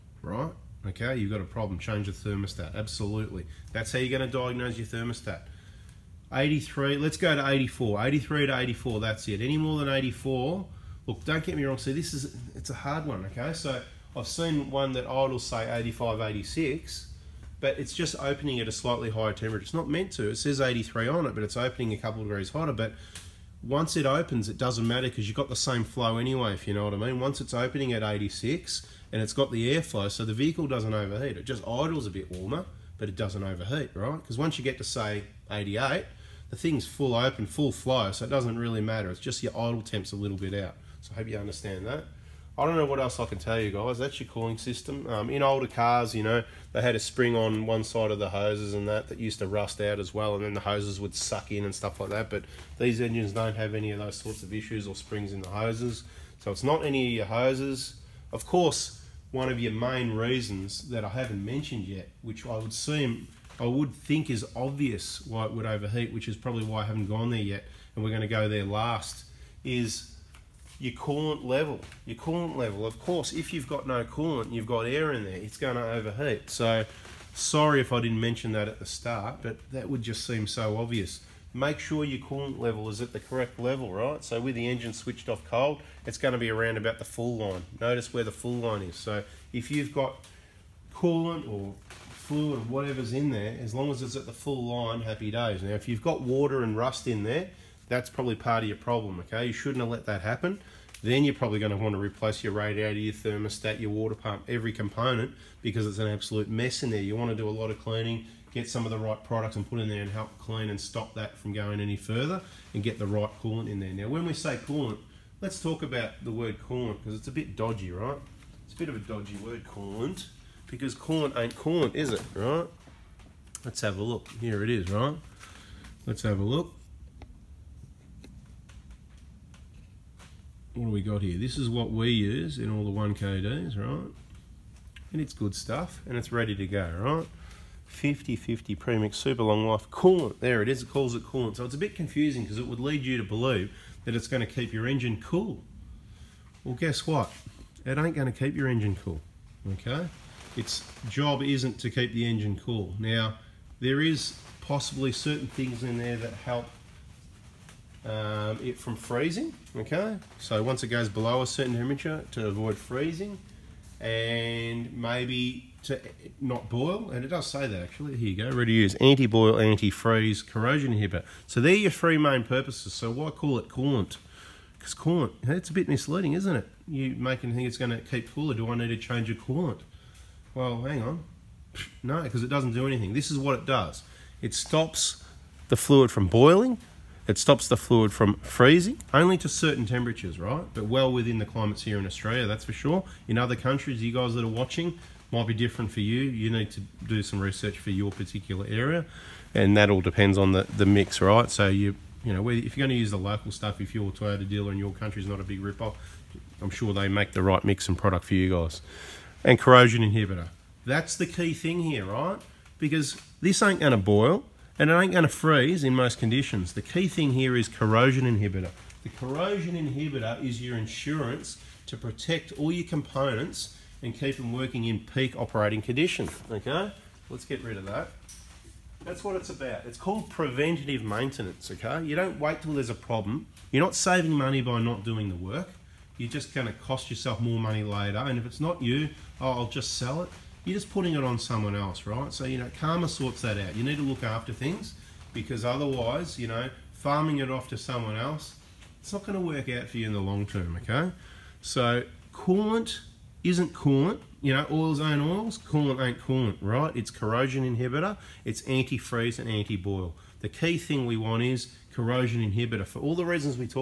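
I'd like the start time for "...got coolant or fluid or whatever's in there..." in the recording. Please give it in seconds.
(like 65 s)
89 s.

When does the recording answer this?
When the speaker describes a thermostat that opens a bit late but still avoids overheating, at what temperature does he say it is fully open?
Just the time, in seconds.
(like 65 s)
35 s.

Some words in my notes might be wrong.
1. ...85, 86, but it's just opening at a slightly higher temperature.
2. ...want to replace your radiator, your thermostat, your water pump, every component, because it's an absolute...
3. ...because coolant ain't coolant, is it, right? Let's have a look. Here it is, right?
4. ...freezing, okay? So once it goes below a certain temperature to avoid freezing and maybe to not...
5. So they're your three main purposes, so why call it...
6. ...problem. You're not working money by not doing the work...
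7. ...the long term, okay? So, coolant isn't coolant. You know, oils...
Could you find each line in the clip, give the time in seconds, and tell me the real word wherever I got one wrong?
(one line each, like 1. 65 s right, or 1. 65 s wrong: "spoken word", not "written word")
1. 15 s right
2. 101 s right
3. 120 s right
4. 158 s right
5. 171 s right
6. 232 s wrong: "saving", not "working"
7. 250 s right.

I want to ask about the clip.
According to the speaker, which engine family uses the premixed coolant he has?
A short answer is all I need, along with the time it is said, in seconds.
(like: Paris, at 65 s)
1KD, at 132 s.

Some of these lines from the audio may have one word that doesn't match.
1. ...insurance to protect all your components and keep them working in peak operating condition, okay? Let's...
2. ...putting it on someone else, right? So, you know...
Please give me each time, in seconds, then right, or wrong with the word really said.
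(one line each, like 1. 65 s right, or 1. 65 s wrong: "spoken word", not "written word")
1. 220 s right
2. 240 s right.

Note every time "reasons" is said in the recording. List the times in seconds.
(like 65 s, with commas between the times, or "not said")
60 s, 263 s.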